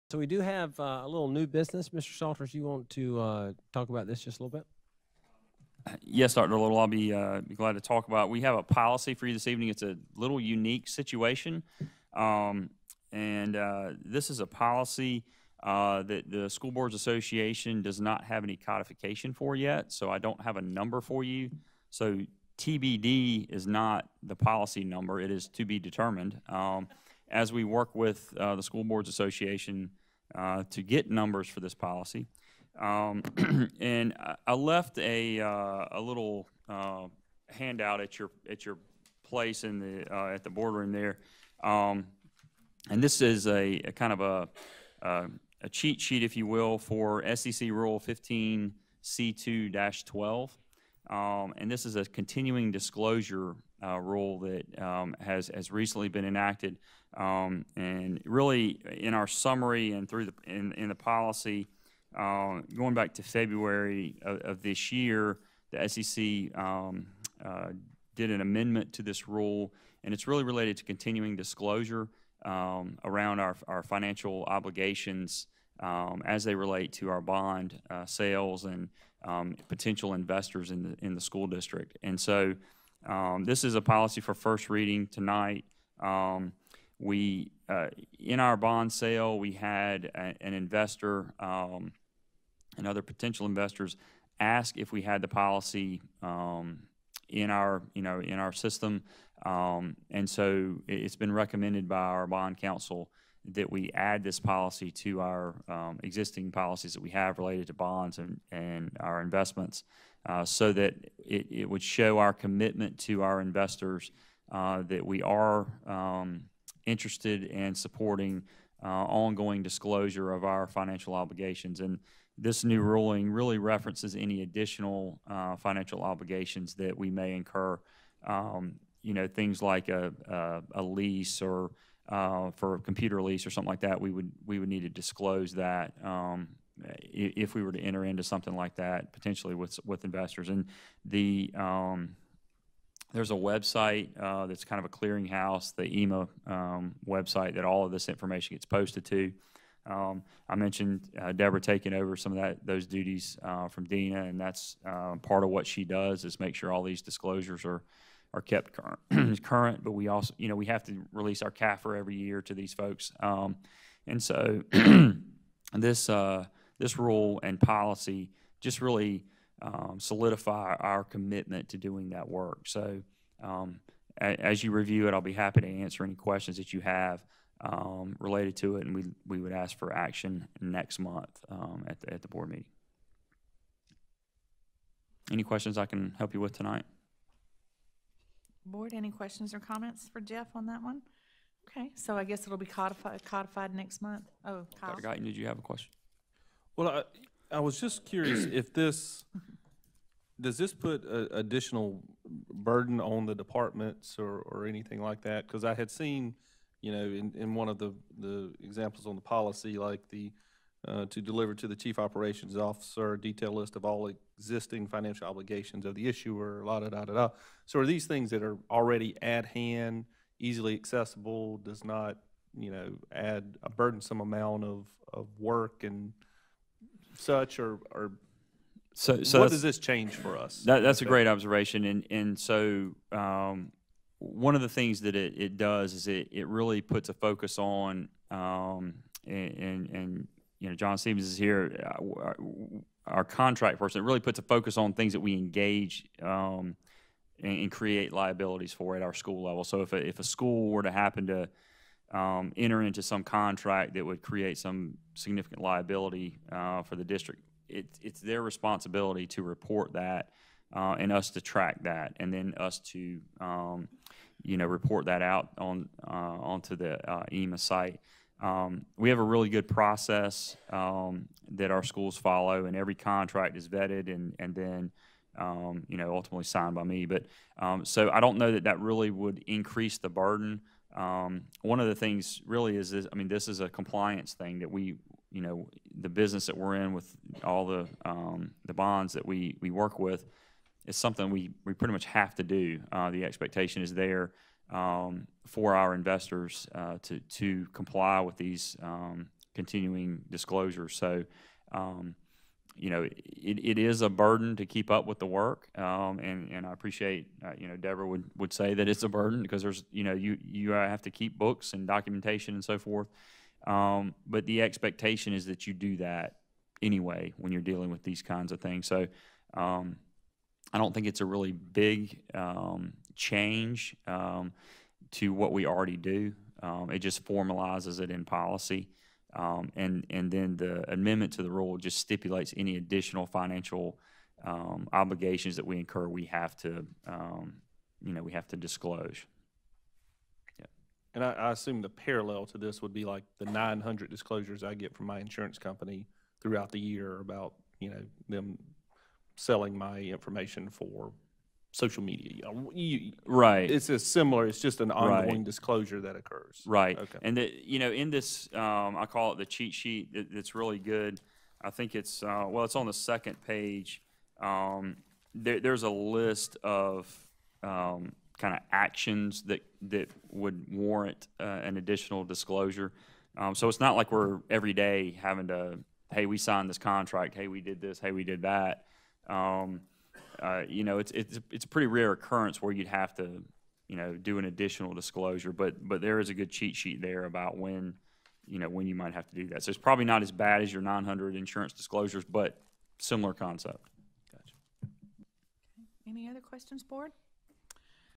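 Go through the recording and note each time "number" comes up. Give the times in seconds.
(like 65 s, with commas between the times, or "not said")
20 s, 24 s, 31 s.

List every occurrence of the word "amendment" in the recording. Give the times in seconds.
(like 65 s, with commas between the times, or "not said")
68 s, 330 s.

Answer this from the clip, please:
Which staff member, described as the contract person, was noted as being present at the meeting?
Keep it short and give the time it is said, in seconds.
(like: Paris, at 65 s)
John Stevens, at 240 s.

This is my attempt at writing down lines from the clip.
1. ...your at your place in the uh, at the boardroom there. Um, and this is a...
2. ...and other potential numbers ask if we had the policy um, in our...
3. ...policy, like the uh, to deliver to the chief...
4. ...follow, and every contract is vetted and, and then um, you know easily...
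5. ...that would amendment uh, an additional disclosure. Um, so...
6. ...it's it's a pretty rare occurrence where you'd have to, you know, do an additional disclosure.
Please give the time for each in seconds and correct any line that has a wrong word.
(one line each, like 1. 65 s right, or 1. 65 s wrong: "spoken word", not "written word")
1. 38 s right
2. 92 s wrong: "investors", not "numbers"
3. 209 s right
4. 272 s wrong: "ultimately", not "easily"
5. 369 s wrong: "warrant", not "amendment"
6. 381 s right.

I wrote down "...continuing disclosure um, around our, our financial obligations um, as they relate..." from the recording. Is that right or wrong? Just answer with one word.
right.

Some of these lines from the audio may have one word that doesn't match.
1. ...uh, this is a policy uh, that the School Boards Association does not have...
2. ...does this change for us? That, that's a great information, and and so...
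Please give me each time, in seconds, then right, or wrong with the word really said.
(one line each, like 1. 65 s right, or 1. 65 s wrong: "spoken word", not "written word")
1. 13 s right
2. 229 s wrong: "observation", not "information".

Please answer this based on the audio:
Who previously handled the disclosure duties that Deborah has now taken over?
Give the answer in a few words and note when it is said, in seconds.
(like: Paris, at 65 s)
Dina, at 153 s.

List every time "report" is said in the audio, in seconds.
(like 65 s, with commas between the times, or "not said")
259 s, 264 s.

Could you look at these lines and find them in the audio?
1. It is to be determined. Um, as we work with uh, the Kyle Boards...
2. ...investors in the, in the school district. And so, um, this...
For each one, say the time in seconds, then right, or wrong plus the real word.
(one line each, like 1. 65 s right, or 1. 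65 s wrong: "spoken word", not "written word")
1. 25 s wrong: "School", not "Kyle"
2. 80 s right.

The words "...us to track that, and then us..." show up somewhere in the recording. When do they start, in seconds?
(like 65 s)
261 s.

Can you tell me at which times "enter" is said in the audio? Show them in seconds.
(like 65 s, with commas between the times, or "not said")
137 s, 252 s.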